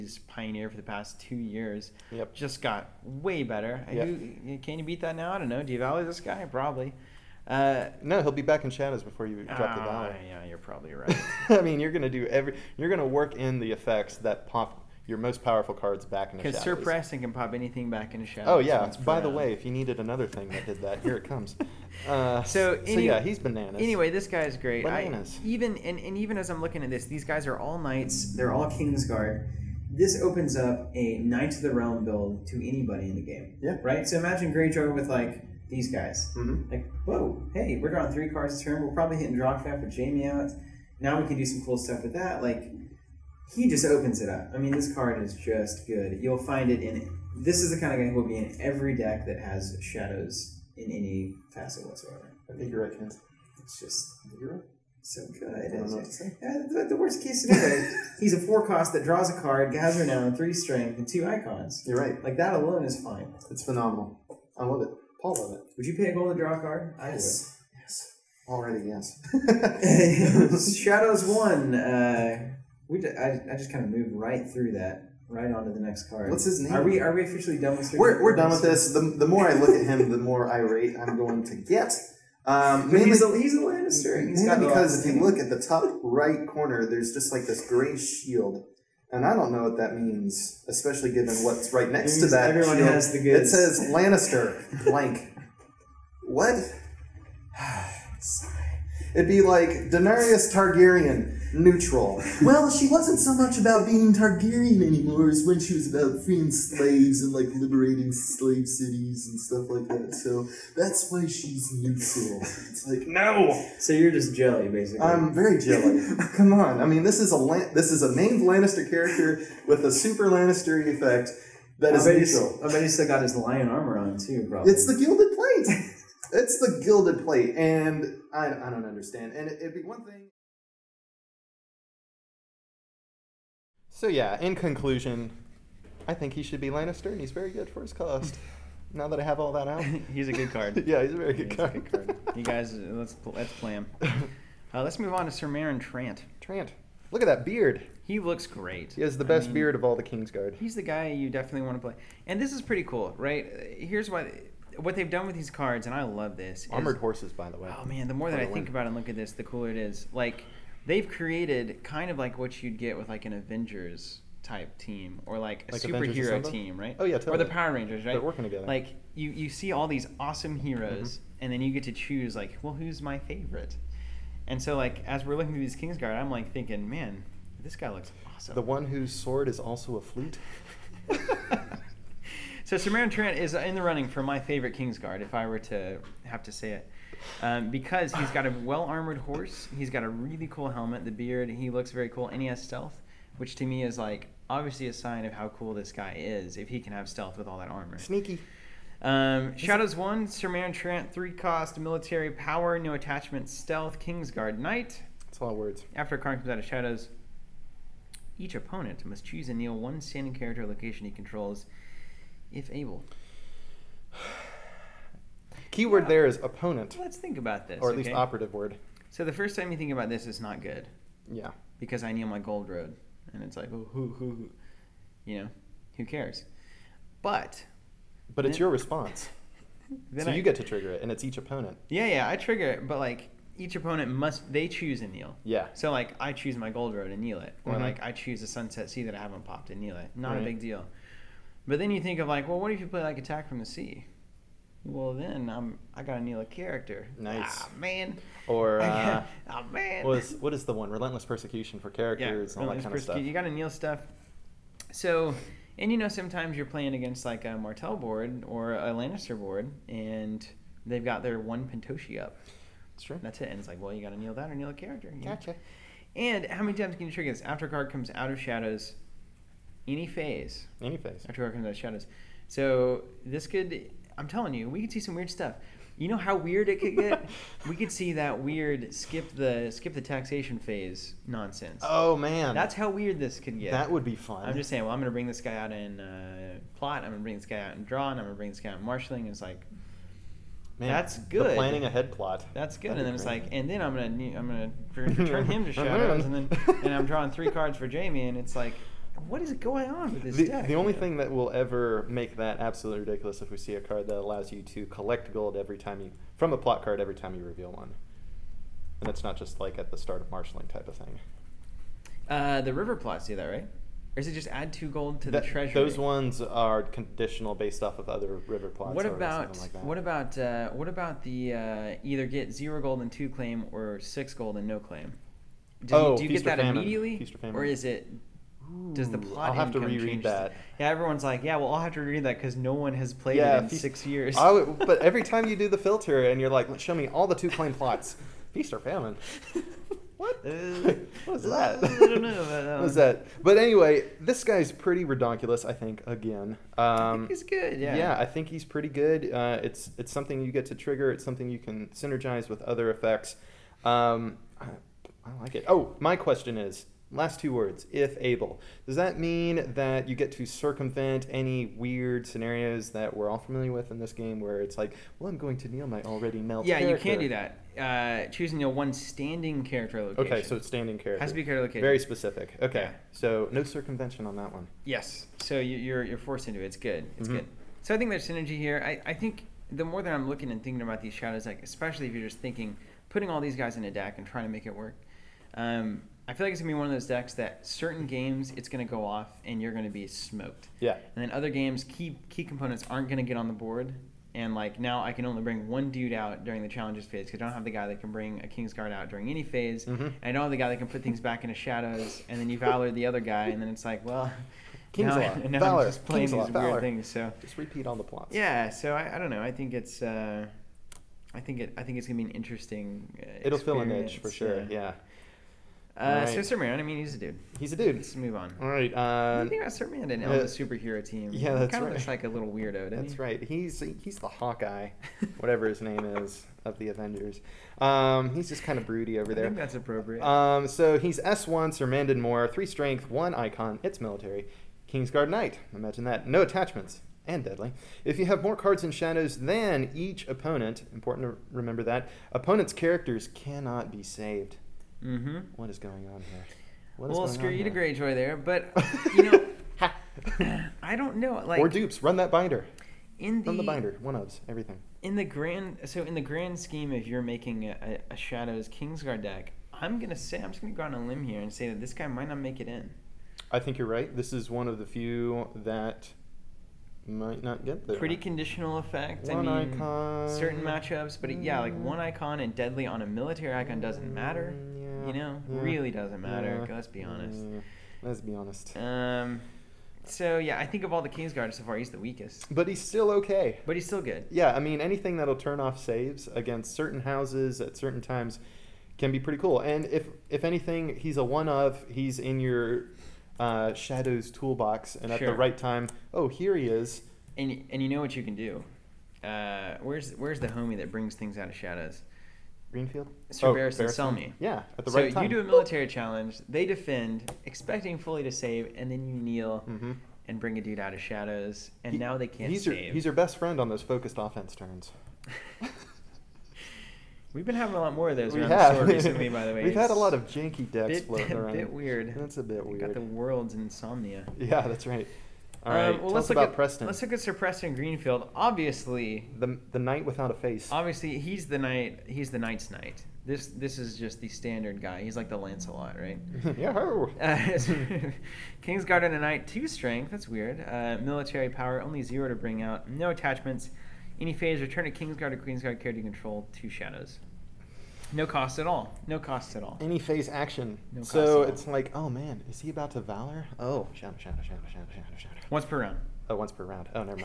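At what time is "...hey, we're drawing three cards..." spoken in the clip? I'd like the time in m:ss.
0:37.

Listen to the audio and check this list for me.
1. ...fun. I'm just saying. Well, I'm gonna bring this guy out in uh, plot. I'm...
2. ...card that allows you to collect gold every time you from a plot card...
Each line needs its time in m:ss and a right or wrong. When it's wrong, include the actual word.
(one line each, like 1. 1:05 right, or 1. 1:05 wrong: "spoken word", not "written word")
1. 4:44 right
2. 5:03 right.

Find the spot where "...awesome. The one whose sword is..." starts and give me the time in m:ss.
2:58.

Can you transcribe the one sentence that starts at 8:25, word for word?
So you do a military challenge.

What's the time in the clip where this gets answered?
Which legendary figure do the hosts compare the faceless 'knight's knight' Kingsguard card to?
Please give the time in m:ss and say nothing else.
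8:55.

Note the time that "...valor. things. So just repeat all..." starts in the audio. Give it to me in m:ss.
6:46.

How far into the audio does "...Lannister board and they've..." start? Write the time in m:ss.
4:18.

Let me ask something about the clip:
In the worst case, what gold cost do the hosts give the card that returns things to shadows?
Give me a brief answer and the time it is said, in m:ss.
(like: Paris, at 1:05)
4, at 0:58.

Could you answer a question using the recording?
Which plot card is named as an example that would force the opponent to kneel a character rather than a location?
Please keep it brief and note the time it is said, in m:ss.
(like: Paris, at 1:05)
Attack from the Sea, at 4:03.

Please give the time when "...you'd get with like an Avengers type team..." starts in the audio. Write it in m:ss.
2:42.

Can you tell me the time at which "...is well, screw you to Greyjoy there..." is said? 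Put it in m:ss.
7:27.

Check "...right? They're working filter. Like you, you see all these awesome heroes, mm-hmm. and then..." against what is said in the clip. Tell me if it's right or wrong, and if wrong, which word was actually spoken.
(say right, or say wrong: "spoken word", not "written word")
wrong: "together", not "filter".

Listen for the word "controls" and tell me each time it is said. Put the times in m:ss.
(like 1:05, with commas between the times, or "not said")
3:31, 9:06.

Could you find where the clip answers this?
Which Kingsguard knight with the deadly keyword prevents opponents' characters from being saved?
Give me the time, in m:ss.
7:11.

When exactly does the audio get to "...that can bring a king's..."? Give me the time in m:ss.
6:37.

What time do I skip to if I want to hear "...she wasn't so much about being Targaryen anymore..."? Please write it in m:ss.
1:42.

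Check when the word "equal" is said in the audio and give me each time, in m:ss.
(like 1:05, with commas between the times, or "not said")
not said.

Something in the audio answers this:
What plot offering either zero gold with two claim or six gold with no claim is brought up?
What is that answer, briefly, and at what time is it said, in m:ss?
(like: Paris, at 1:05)
Feast or Famine, at 5:38.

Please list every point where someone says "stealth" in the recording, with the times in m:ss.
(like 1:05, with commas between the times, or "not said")
3:12, 3:17, 3:23.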